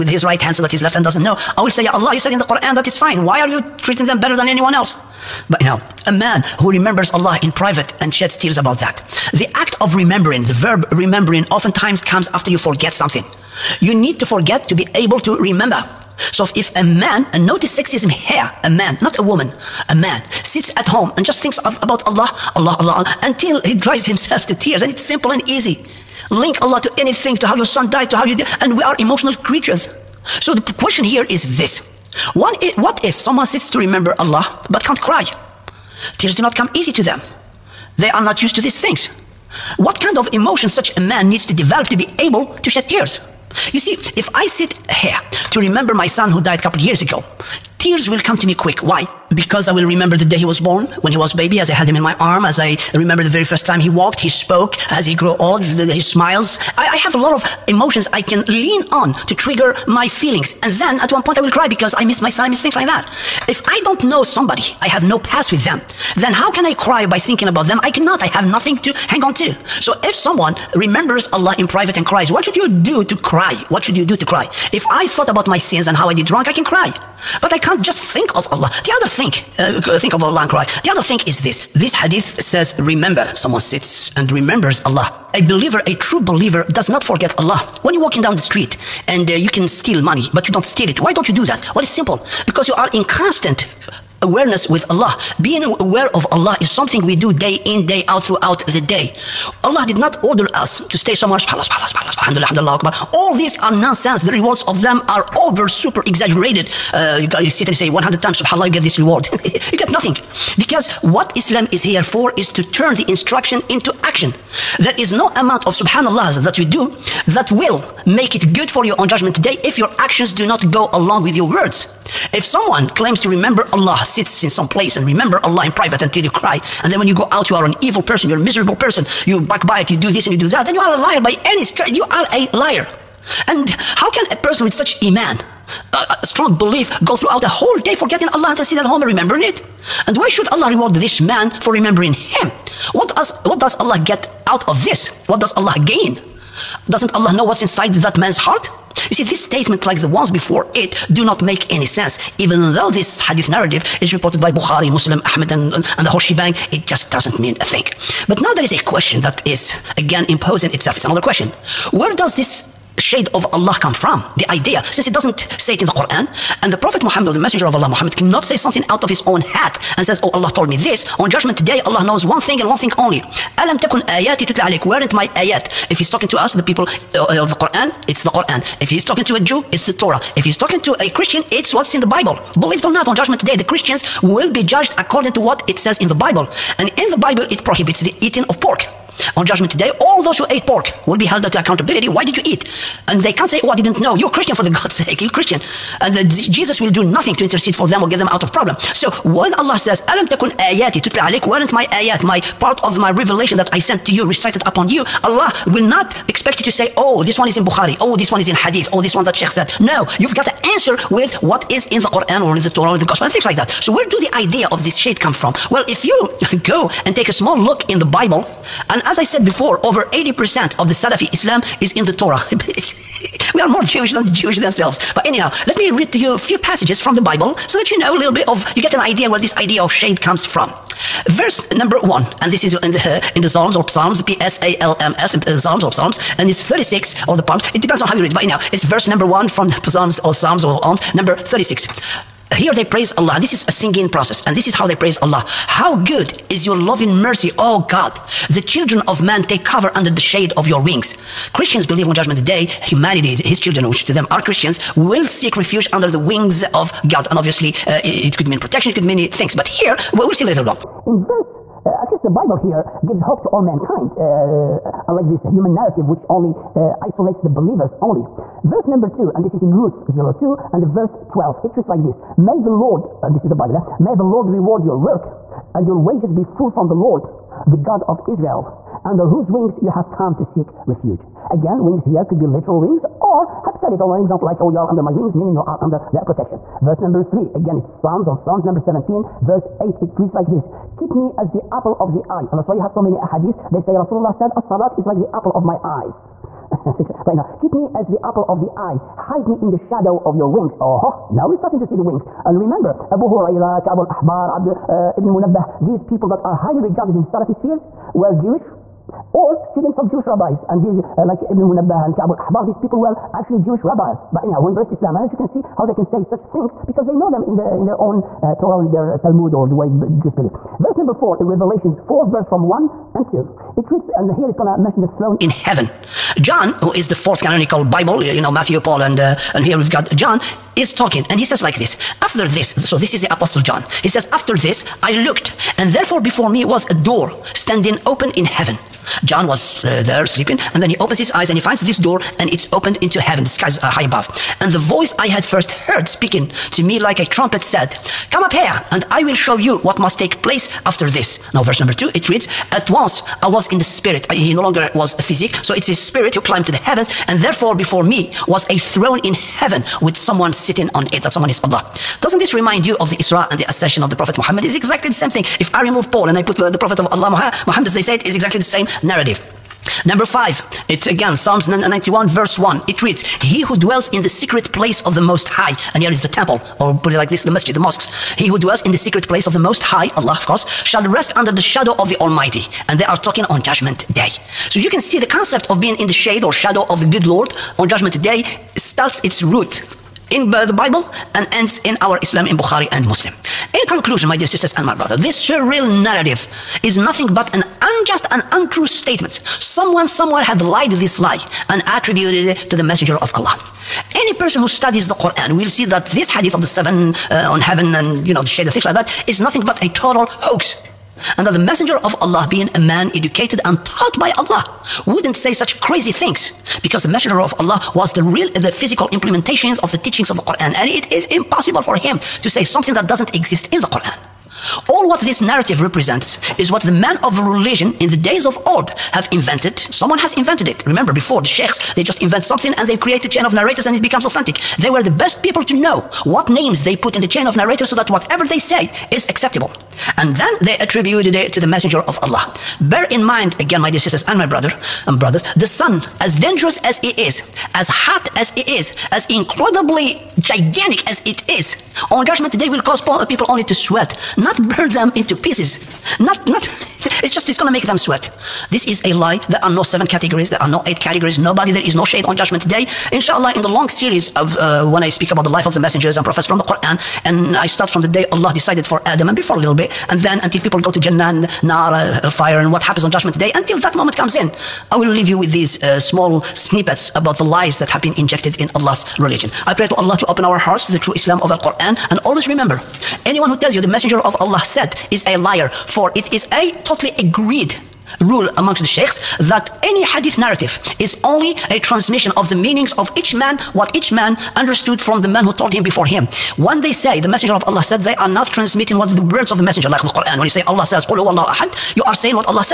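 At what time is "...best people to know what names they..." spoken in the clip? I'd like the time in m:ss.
7:15.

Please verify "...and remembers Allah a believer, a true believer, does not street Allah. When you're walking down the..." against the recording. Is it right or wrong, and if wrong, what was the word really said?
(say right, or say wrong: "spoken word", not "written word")
wrong: "forget", not "street".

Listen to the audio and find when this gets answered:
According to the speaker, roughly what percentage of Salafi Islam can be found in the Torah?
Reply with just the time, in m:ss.
3:39.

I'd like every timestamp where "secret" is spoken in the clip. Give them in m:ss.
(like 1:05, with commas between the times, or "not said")
6:14, 6:18.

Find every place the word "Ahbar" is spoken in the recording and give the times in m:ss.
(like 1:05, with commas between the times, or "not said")
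5:03, 5:12.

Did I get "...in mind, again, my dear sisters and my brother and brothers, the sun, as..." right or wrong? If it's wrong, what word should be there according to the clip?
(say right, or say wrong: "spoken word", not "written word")
right.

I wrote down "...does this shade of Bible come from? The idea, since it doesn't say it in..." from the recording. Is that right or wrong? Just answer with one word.
wrong.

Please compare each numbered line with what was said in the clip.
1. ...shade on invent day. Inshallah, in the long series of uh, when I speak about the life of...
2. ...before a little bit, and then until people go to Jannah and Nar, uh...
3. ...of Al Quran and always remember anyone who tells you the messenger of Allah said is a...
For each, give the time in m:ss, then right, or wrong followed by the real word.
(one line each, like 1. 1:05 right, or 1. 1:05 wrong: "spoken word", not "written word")
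1. 7:42 wrong: "judgment", not "invent"
2. 7:49 right
3. 8:01 right.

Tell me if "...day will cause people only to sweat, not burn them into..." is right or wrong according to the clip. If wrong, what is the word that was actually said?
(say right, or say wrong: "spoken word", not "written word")
right.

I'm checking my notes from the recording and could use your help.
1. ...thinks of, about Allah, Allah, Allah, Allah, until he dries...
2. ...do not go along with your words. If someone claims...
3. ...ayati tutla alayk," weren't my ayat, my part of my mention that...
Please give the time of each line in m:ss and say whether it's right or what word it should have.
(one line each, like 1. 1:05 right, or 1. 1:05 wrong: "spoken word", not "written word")
1. 0:21 right
2. 2:00 right
3. 3:20 wrong: "revelation", not "mention".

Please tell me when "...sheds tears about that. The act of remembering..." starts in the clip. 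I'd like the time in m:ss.
0:08.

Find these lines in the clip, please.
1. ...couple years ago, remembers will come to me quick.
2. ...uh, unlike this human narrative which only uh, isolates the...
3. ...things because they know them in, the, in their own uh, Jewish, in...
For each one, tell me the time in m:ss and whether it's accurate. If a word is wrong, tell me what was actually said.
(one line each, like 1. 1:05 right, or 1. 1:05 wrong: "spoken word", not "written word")
1. 0:46 wrong: "tears", not "remembers"
2. 4:24 right
3. 5:16 wrong: "Torah", not "Jewish".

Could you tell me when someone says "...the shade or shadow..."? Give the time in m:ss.
6:26.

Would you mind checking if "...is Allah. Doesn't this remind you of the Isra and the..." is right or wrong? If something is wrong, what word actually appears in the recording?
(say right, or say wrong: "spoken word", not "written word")
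right.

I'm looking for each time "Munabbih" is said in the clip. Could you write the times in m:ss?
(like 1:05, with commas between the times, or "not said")
5:05, 5:11.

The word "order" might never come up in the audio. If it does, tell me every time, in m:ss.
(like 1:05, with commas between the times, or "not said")
1:40.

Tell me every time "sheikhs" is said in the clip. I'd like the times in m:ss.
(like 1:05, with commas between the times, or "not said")
3:29, 7:11, 8:08.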